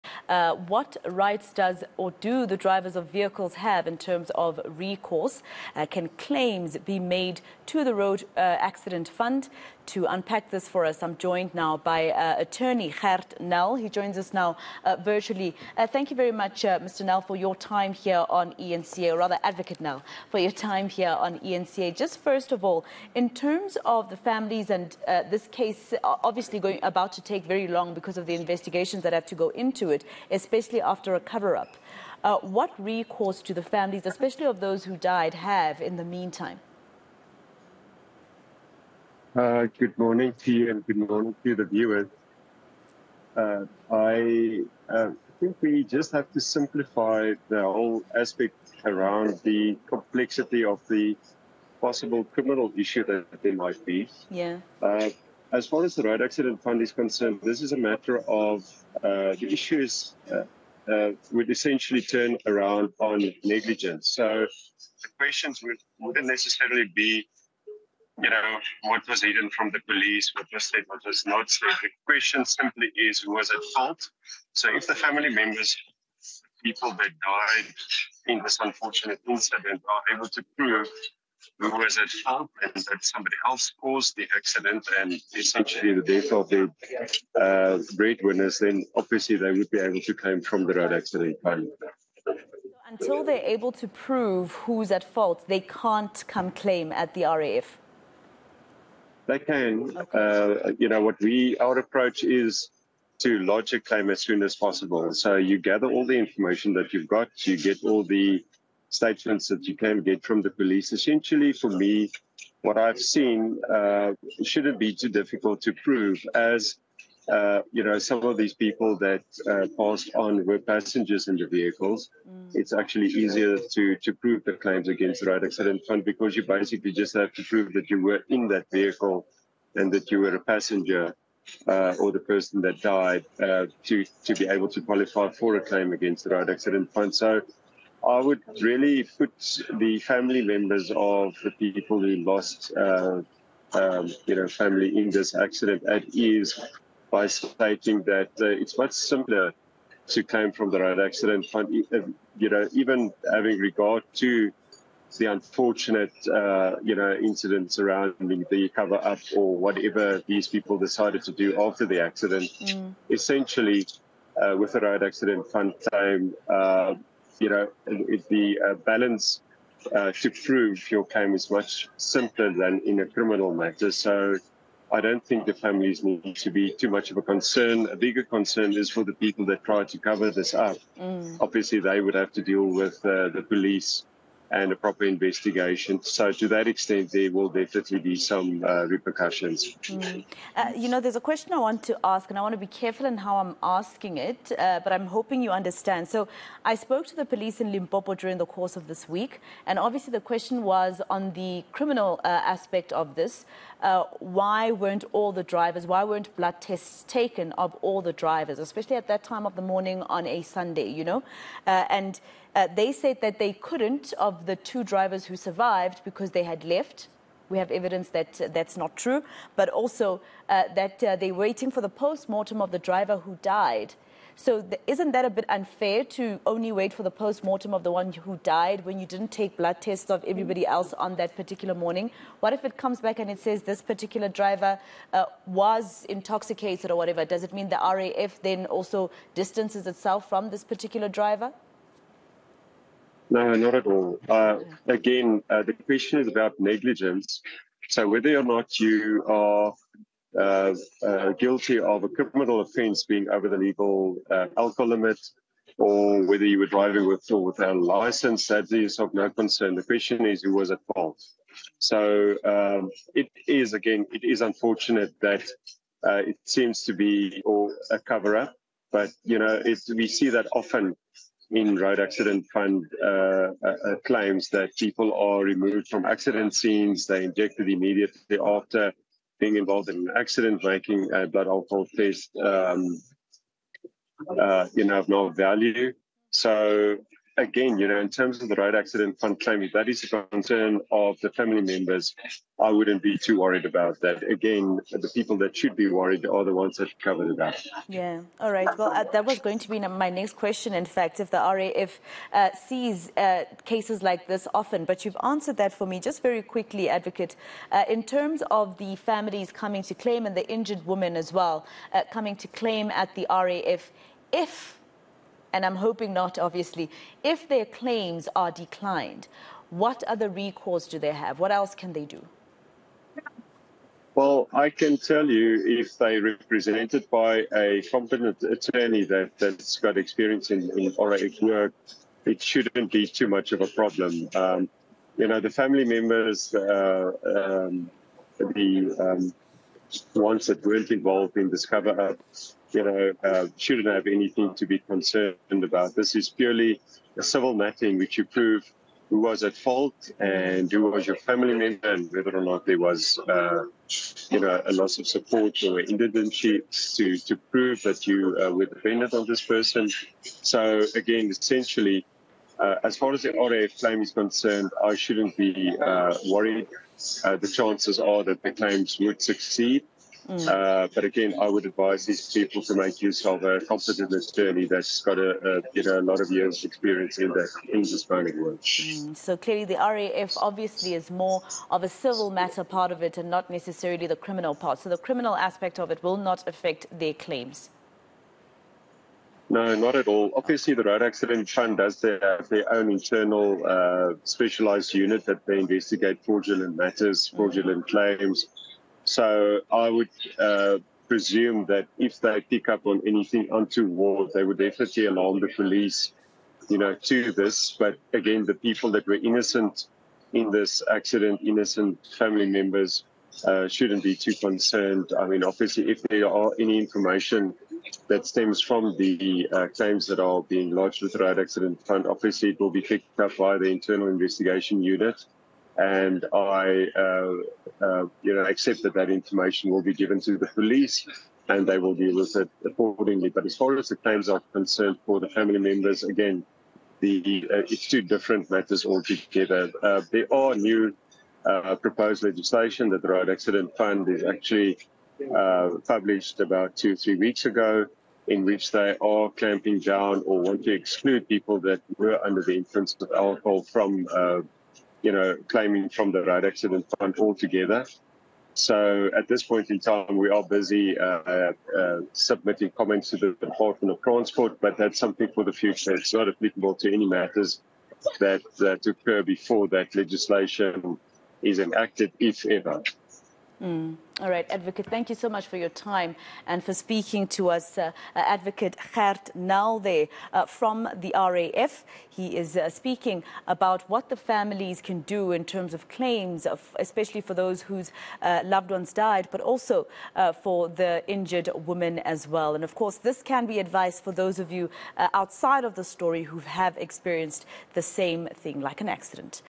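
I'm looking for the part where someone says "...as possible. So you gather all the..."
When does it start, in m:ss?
1:44.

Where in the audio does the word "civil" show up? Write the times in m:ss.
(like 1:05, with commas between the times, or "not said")
5:47, 6:21.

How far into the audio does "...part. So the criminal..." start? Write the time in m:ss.
6:24.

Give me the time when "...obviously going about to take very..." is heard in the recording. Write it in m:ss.
0:26.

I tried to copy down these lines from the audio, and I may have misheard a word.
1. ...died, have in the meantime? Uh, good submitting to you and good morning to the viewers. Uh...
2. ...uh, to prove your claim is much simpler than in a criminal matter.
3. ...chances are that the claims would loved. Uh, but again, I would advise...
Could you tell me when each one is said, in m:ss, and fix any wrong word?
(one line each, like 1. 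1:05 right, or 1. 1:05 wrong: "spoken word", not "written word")
1. 0:34 wrong: "morning", not "submitting"
2. 2:49 right
3. 6:07 wrong: "succeed", not "loved".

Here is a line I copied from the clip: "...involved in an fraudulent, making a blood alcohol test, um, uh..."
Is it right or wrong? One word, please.
wrong.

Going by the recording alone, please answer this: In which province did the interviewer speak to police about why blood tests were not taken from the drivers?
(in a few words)
Limpopo.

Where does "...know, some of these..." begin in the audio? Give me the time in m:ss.
1:57.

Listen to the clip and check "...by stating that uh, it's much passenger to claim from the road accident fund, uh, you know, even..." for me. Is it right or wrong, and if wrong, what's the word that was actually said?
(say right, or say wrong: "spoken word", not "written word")
wrong: "simpler", not "passenger".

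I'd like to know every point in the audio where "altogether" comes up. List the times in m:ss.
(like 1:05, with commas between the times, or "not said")
7:18, 7:37.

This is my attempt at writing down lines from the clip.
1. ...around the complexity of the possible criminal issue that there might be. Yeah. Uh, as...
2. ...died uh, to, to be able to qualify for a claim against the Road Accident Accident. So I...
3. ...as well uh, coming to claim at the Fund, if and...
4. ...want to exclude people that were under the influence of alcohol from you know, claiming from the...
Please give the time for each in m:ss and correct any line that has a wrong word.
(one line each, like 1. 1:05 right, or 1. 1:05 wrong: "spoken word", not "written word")
1. 0:48 right
2. 2:12 wrong: "Fund", not "Accident"
3. 5:11 wrong: "RAF", not "Fund"
4. 7:30 right.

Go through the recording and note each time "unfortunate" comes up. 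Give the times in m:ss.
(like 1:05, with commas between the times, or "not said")
1:18, 2:35, 4:24.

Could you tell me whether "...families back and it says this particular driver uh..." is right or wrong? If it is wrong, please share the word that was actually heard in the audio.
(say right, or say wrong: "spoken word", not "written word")
wrong: "comes", not "families".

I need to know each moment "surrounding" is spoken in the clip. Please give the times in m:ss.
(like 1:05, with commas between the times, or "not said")
2:37.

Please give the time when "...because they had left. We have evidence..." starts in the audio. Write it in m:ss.
3:36.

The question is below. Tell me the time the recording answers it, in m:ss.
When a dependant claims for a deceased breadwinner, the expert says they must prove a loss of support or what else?
5:55.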